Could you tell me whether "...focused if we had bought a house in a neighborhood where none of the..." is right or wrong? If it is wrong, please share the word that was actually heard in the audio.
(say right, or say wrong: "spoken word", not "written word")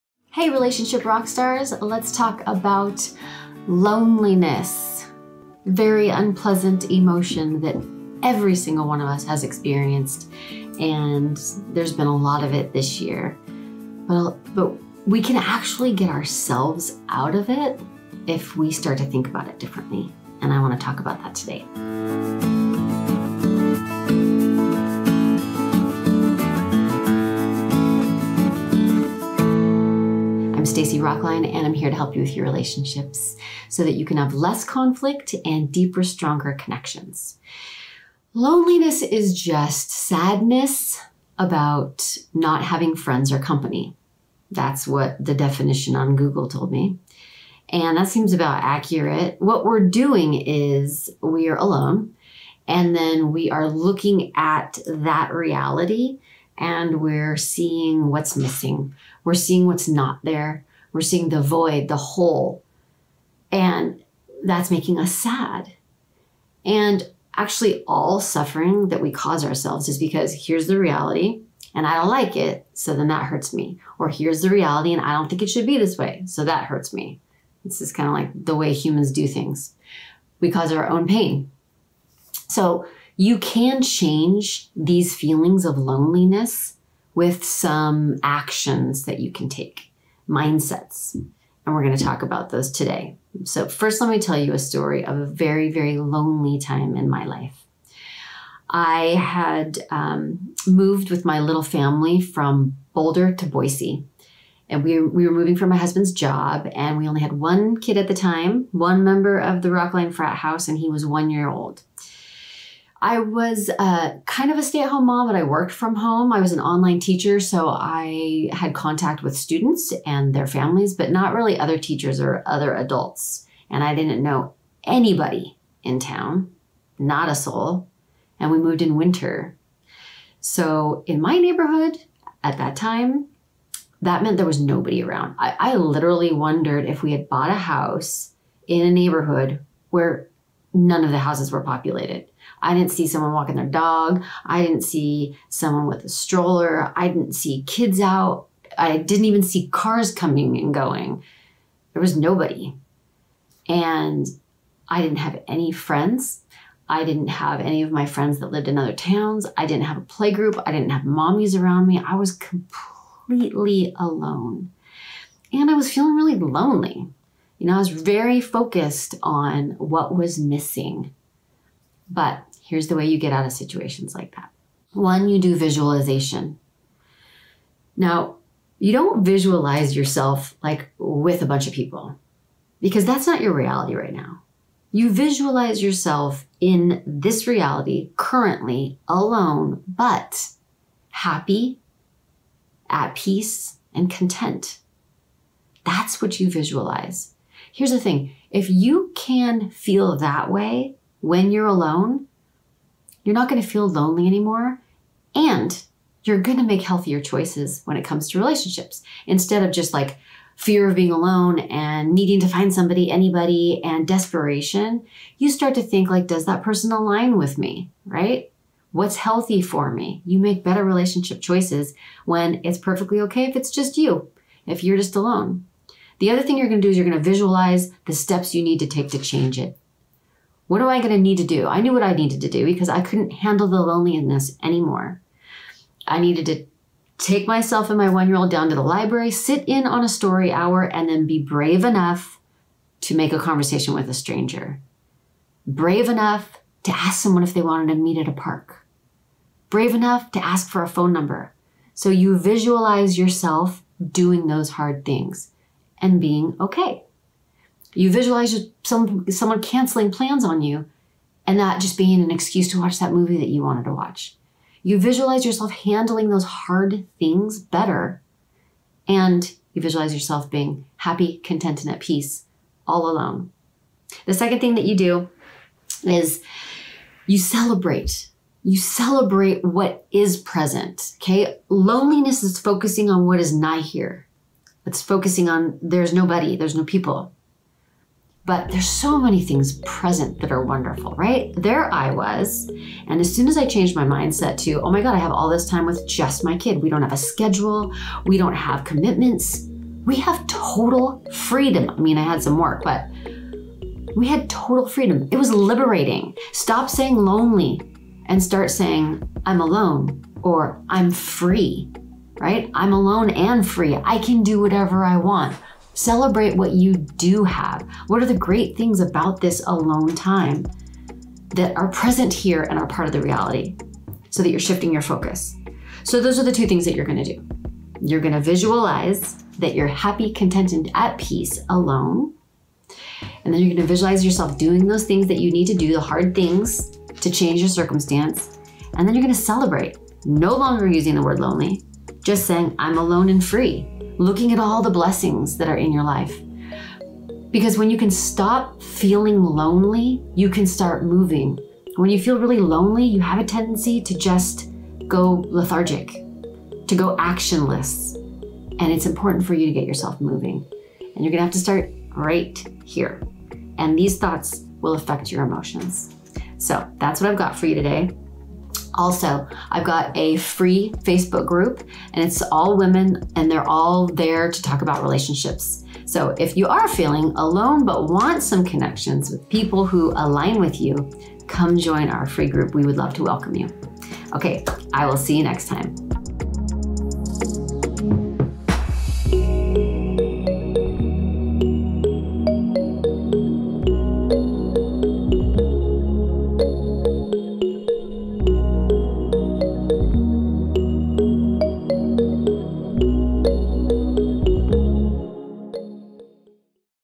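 wrong: "wondered", not "focused".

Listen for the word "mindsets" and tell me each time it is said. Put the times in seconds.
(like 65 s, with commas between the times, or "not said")
90 s, 294 s.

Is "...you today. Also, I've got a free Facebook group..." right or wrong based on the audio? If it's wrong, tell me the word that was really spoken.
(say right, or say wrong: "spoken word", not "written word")
right.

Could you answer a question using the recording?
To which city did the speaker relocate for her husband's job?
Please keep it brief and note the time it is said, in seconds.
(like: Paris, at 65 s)
Boise, at 103 s.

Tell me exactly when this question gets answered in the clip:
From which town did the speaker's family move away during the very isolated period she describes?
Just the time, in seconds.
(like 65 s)
102 s.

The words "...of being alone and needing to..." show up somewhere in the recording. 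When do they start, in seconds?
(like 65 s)
210 s.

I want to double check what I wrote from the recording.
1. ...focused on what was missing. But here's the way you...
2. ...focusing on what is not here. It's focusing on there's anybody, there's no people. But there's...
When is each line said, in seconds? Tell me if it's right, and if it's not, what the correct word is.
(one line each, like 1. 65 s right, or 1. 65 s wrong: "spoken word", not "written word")
1. 168 s right
2. 282 s wrong: "nobody", not "anybody".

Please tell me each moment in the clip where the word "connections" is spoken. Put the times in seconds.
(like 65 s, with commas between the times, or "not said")
36 s, 378 s.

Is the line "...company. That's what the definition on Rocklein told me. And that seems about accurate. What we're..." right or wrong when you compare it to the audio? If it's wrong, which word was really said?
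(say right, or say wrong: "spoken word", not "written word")
wrong: "Google", not "Rocklein".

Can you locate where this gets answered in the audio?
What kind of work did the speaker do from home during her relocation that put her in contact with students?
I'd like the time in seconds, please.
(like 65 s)
116 s.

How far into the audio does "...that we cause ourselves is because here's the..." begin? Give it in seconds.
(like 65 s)
68 s.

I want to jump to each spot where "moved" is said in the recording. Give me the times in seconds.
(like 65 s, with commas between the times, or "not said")
100 s, 128 s.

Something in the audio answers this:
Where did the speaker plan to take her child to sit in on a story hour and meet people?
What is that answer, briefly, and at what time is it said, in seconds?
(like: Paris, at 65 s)
the library, at 238 s.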